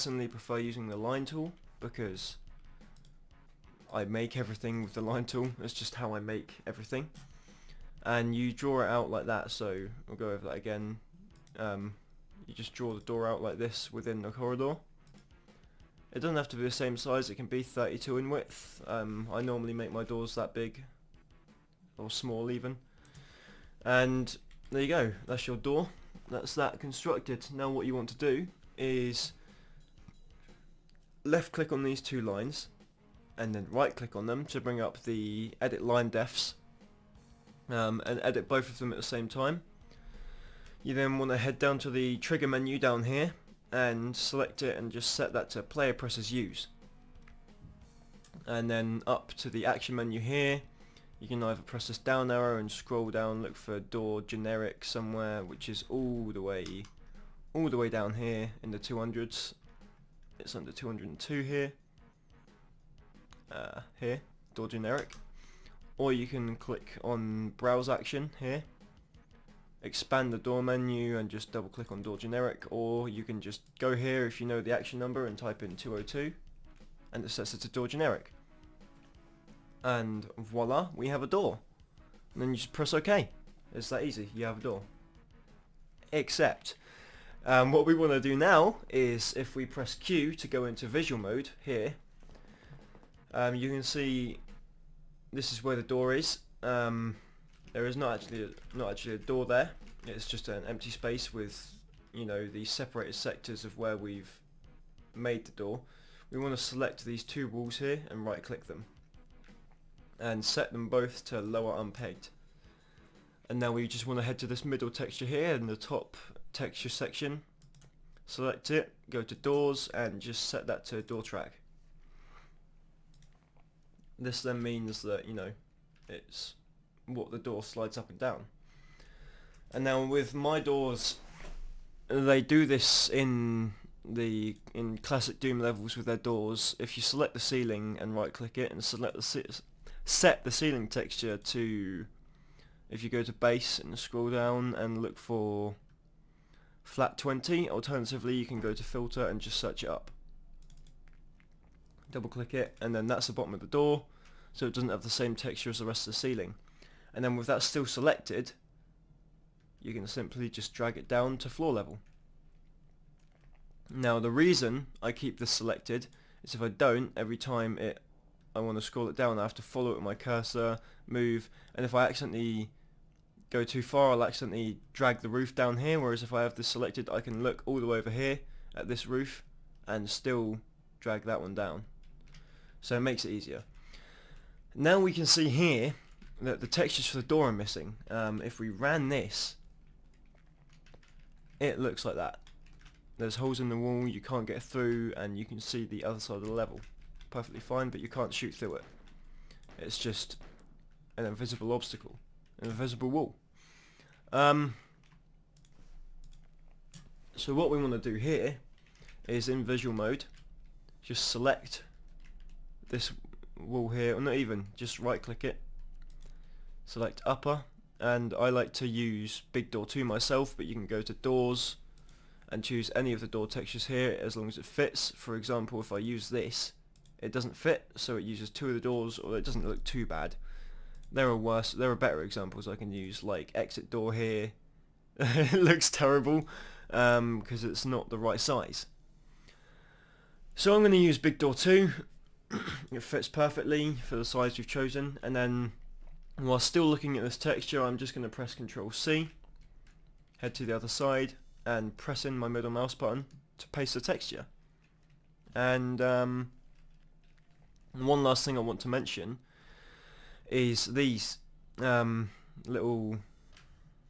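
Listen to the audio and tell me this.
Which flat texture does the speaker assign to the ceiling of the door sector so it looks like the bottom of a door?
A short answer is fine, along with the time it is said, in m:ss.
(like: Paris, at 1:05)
Flat 20, at 2:26.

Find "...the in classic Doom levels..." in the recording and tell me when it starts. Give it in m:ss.
2:14.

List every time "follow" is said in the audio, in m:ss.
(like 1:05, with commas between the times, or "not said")
2:49.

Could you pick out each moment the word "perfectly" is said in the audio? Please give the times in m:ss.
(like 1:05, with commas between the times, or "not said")
3:17, 4:03.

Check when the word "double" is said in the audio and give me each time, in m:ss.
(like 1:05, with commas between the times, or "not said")
1:11, 2:32.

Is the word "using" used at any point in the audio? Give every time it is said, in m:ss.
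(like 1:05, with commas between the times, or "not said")
0:00.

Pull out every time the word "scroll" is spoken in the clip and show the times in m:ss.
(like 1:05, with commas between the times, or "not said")
0:52, 2:23, 2:48.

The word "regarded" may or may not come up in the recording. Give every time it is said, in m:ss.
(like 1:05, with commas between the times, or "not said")
not said.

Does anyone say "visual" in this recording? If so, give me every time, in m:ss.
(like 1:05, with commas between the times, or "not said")
1:30, 3:29.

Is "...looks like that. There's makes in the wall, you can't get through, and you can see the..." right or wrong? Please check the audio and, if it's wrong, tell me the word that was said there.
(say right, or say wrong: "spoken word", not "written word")
wrong: "holes", not "makes".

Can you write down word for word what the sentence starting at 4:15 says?
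And um, one last thing I want to mention is these um, little...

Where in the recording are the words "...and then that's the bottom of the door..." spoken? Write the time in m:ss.
2:32.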